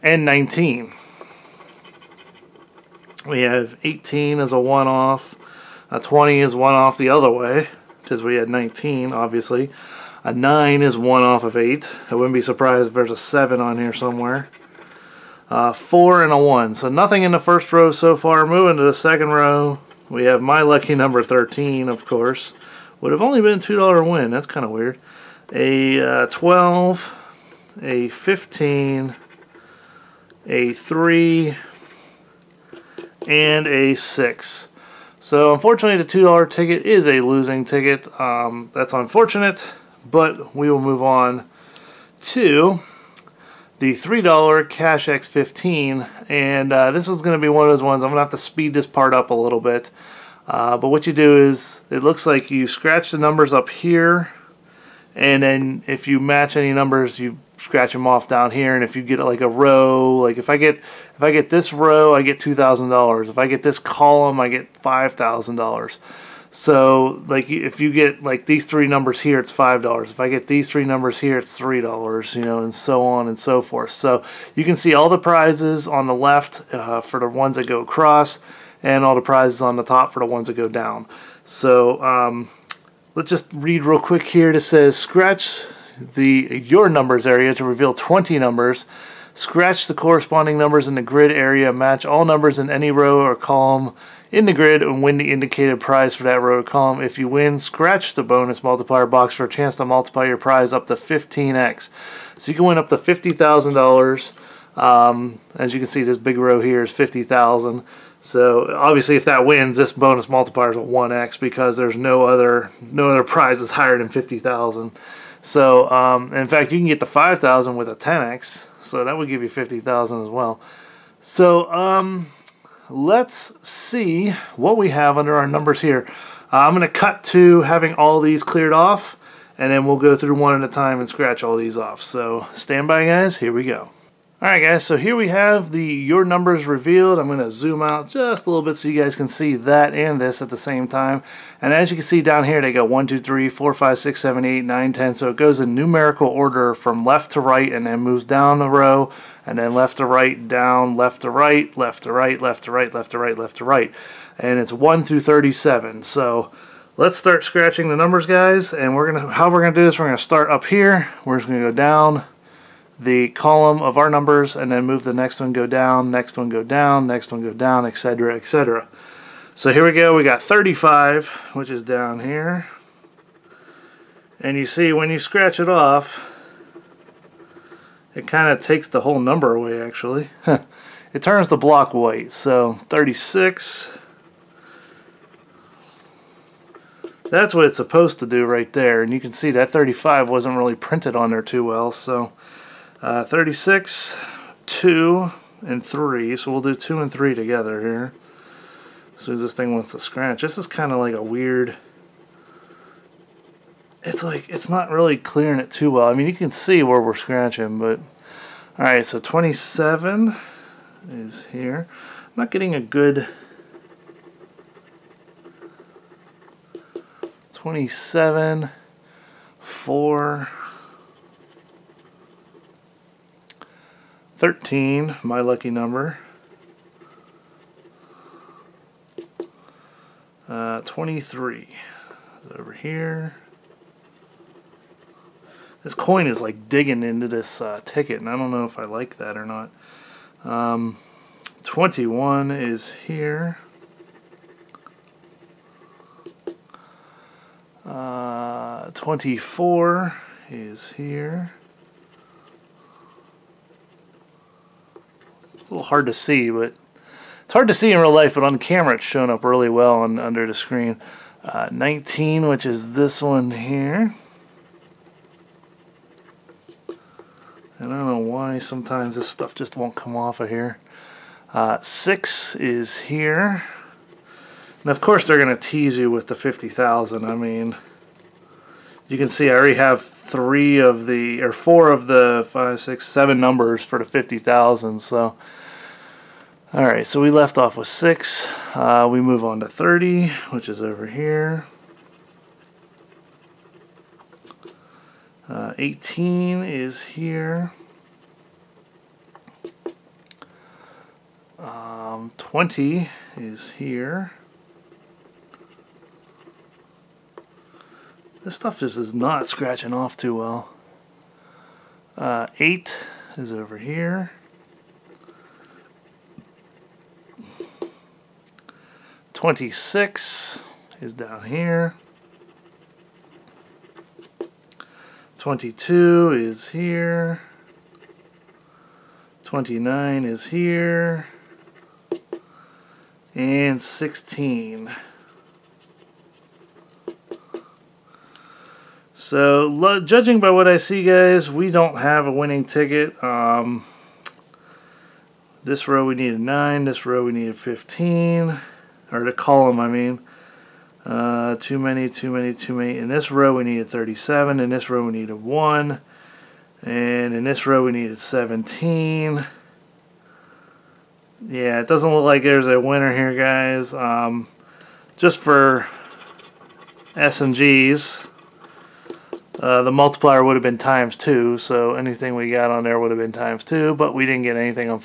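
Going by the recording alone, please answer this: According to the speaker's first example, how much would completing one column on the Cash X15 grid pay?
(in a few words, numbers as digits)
$5,000.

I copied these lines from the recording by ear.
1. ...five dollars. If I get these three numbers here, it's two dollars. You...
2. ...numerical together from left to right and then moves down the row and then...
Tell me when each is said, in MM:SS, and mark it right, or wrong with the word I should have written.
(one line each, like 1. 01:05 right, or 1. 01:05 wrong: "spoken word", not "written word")
1. 01:09 wrong: "three", not "two"
2. 02:25 wrong: "order", not "together".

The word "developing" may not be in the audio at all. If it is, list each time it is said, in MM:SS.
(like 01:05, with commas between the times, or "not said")
not said.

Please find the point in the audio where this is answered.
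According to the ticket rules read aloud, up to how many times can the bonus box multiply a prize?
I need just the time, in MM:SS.
01:40.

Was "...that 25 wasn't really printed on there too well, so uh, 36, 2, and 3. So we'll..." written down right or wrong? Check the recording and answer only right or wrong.
wrong.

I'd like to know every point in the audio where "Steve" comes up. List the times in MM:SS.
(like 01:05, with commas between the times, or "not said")
not said.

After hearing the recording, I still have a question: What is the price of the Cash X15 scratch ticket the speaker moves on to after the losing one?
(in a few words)
$3.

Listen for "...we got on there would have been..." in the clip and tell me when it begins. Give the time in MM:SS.
06:12.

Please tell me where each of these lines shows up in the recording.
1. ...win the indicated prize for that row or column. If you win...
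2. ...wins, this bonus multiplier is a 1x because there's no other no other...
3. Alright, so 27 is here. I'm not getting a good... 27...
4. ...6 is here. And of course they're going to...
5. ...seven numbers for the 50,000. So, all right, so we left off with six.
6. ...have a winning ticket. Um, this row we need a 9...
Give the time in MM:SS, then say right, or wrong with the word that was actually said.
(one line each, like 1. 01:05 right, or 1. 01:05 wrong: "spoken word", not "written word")
1. 01:35 right
2. 01:49 right
3. 03:28 right
4. 04:31 right
5. 04:43 right
6. 05:41 right.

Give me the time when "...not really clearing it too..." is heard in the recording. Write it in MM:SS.
03:24.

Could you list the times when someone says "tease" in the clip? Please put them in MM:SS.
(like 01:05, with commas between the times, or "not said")
04:35.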